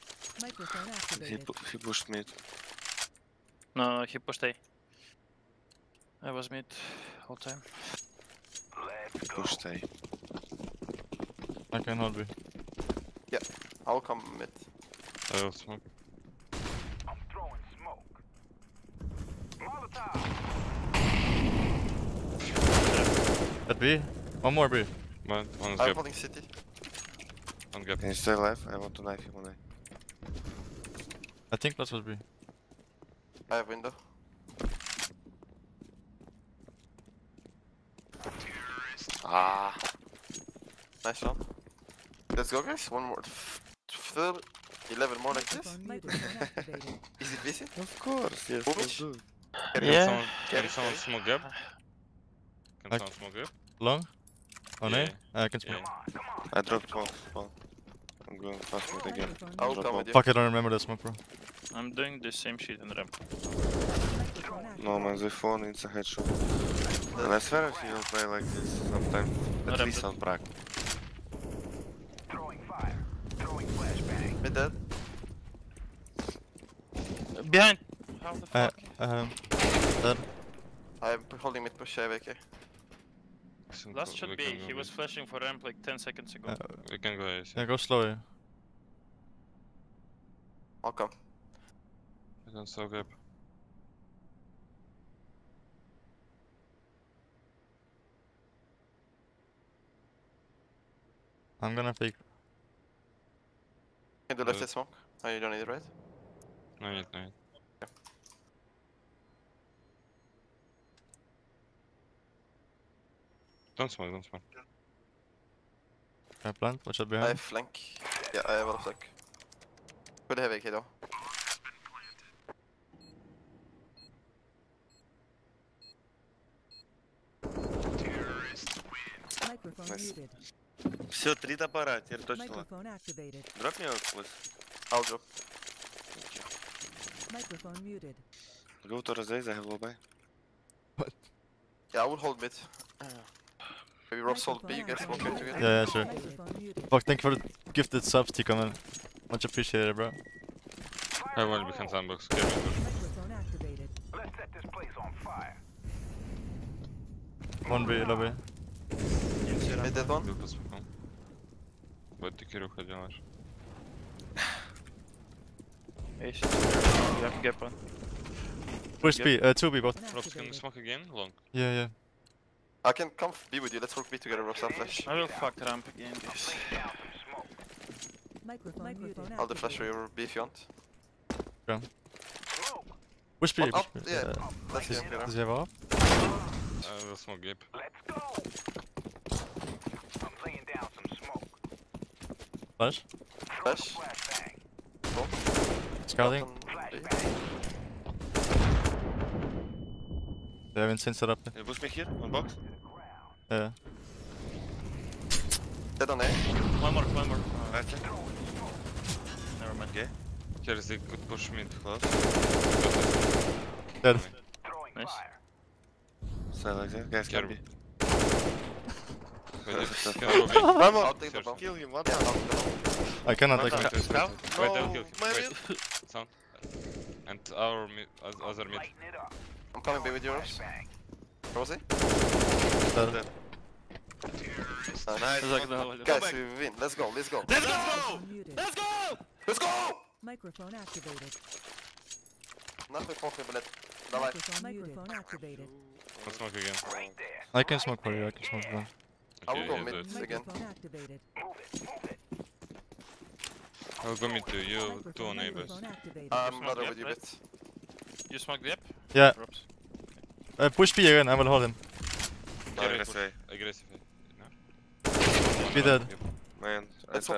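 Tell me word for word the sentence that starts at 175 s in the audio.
I will fuck ramp again, please.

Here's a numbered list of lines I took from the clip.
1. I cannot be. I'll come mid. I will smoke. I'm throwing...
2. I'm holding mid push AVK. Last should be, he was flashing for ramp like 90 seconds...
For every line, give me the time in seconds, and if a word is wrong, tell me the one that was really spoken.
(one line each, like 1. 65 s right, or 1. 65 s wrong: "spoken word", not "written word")
1. 11 s right
2. 81 s wrong: "10", not "90".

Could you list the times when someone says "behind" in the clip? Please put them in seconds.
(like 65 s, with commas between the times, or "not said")
77 s, 117 s.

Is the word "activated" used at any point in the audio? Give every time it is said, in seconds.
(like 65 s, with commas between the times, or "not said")
240 s, 245 s, 250 s.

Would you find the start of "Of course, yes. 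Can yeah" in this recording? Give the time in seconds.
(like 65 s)
47 s.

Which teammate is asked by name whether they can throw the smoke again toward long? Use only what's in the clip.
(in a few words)
ropz.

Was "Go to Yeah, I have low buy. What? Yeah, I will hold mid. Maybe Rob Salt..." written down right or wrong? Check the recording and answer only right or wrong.
wrong.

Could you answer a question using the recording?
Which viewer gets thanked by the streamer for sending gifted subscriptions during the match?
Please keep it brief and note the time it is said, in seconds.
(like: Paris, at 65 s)
Tico, at 148 s.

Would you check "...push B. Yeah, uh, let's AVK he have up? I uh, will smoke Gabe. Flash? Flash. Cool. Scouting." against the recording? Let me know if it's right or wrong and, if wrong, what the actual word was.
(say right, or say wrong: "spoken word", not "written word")
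wrong: "Does", not "AVK".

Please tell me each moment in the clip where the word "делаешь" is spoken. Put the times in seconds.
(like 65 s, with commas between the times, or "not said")
162 s.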